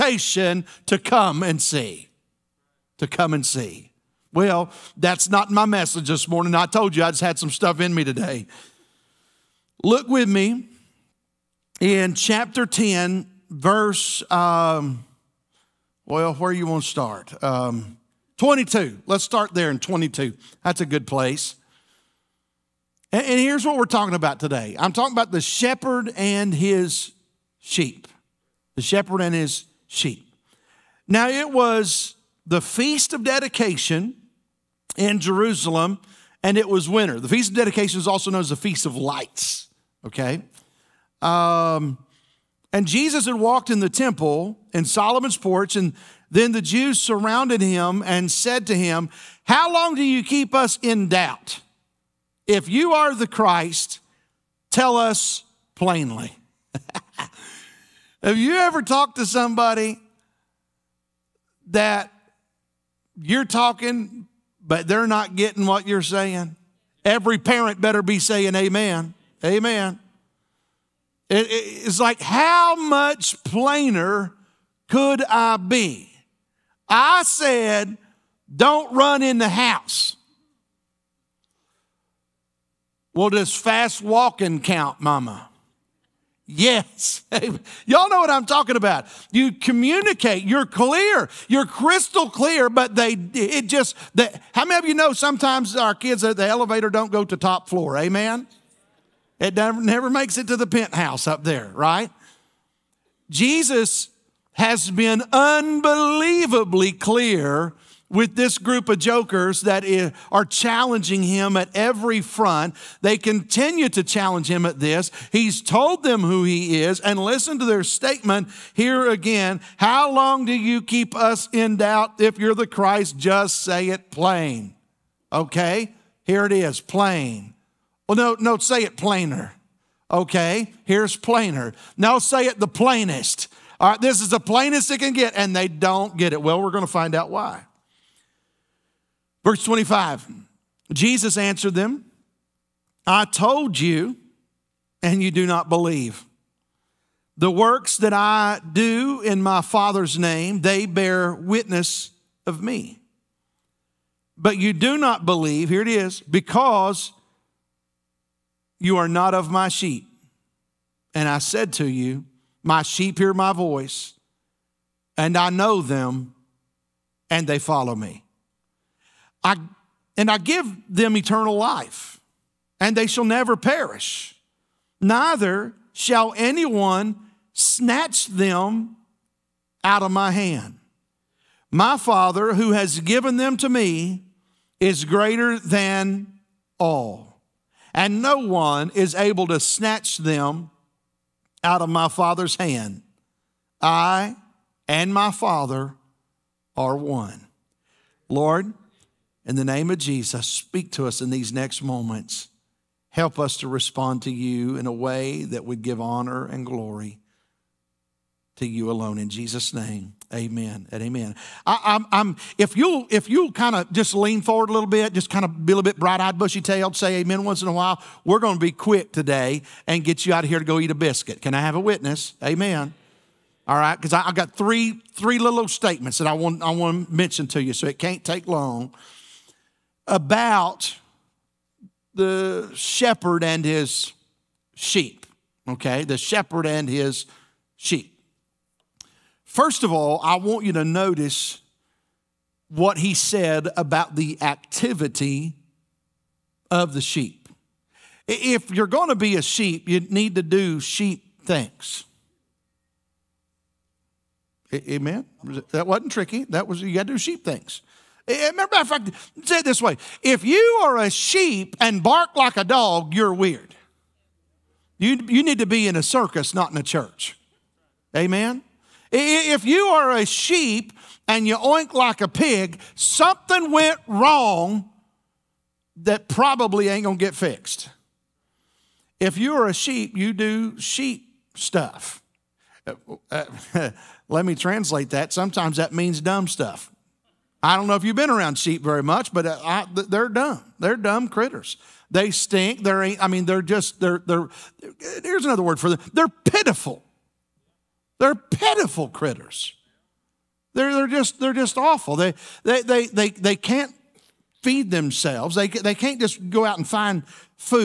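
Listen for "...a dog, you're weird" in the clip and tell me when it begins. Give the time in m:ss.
4:22.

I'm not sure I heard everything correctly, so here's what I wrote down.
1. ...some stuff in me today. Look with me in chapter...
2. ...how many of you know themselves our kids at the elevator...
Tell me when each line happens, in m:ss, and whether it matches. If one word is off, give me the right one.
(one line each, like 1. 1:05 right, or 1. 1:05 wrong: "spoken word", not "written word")
1. 0:07 right
2. 1:34 wrong: "sometimes", not "themselves".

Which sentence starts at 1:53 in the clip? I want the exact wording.
They continue to challenge him at this.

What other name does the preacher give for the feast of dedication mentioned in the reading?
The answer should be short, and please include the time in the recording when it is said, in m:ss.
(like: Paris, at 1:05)
Feast of lights, at 0:38.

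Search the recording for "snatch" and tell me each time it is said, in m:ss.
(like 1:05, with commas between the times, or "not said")
2:57, 3:09.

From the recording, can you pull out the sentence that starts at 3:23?
Help us to respond to you in a way that would give honor and glory to you alone.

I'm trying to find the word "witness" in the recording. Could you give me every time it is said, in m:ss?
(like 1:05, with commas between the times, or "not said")
2:31, 3:41.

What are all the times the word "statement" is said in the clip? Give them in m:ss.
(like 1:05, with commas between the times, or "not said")
1:57, 3:45.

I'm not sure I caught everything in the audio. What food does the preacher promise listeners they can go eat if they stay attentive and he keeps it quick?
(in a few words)
A biscuit.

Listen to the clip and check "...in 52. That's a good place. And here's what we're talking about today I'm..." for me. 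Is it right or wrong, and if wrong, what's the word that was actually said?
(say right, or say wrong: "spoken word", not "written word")
wrong: "22", not "52".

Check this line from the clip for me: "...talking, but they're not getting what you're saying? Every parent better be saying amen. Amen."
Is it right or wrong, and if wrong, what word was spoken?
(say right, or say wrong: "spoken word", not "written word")
right.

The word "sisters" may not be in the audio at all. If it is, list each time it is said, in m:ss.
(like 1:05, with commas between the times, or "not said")
not said.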